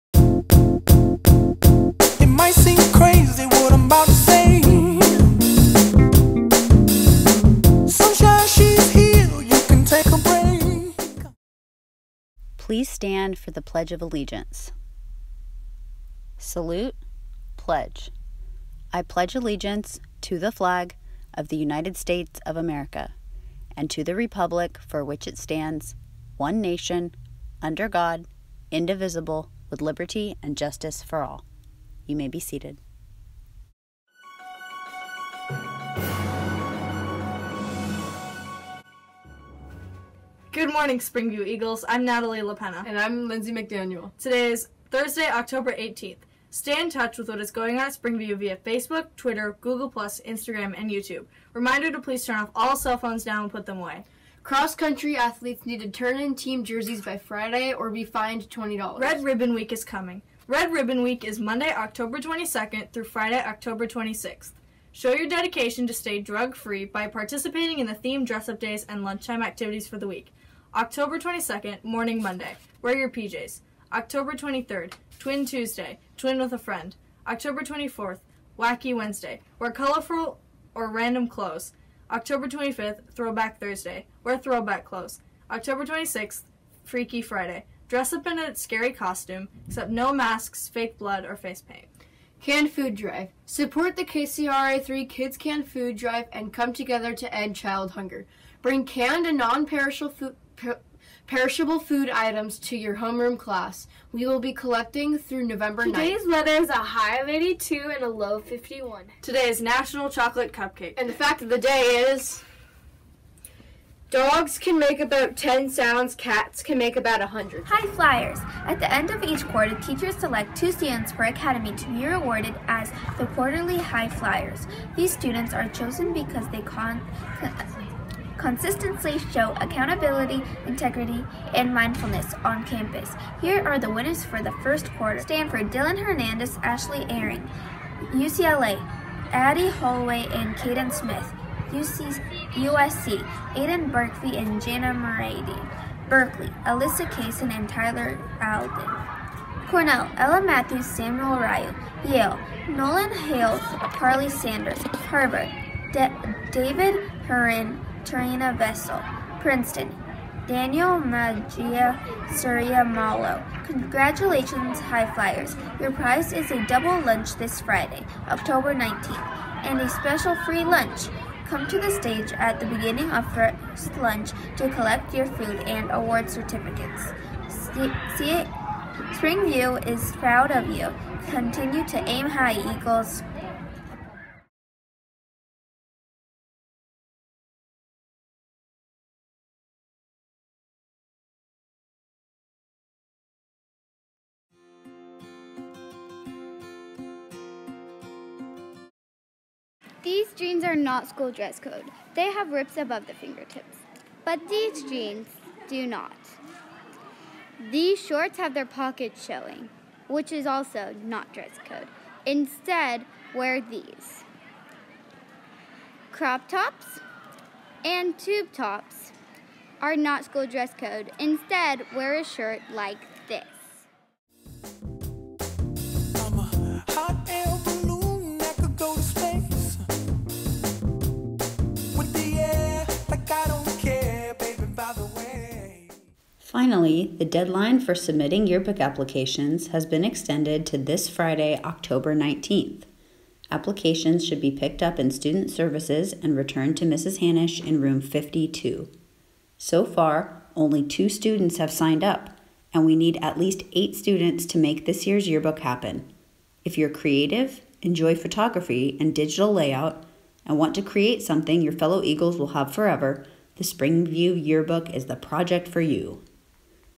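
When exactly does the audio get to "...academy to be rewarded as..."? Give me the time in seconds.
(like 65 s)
121 s.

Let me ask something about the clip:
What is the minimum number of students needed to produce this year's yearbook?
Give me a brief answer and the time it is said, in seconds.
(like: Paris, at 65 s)
8, at 253 s.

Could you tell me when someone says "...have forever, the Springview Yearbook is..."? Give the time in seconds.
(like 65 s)
262 s.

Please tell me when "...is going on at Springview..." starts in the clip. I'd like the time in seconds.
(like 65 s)
47 s.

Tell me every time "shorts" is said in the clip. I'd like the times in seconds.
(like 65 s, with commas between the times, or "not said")
208 s.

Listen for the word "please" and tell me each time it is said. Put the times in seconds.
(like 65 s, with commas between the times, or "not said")
12 s, 52 s.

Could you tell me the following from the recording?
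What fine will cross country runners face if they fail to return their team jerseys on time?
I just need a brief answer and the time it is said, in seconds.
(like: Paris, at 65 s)
$20, at 58 s.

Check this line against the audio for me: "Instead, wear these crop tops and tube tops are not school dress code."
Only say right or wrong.
right.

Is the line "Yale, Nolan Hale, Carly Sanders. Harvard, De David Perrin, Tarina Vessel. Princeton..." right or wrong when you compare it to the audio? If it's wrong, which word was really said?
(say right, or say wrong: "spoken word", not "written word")
right.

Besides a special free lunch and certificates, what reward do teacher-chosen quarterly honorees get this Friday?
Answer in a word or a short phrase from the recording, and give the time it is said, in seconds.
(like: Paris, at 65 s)
a double lunch, at 166 s.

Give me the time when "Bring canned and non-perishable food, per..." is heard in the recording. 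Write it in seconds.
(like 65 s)
98 s.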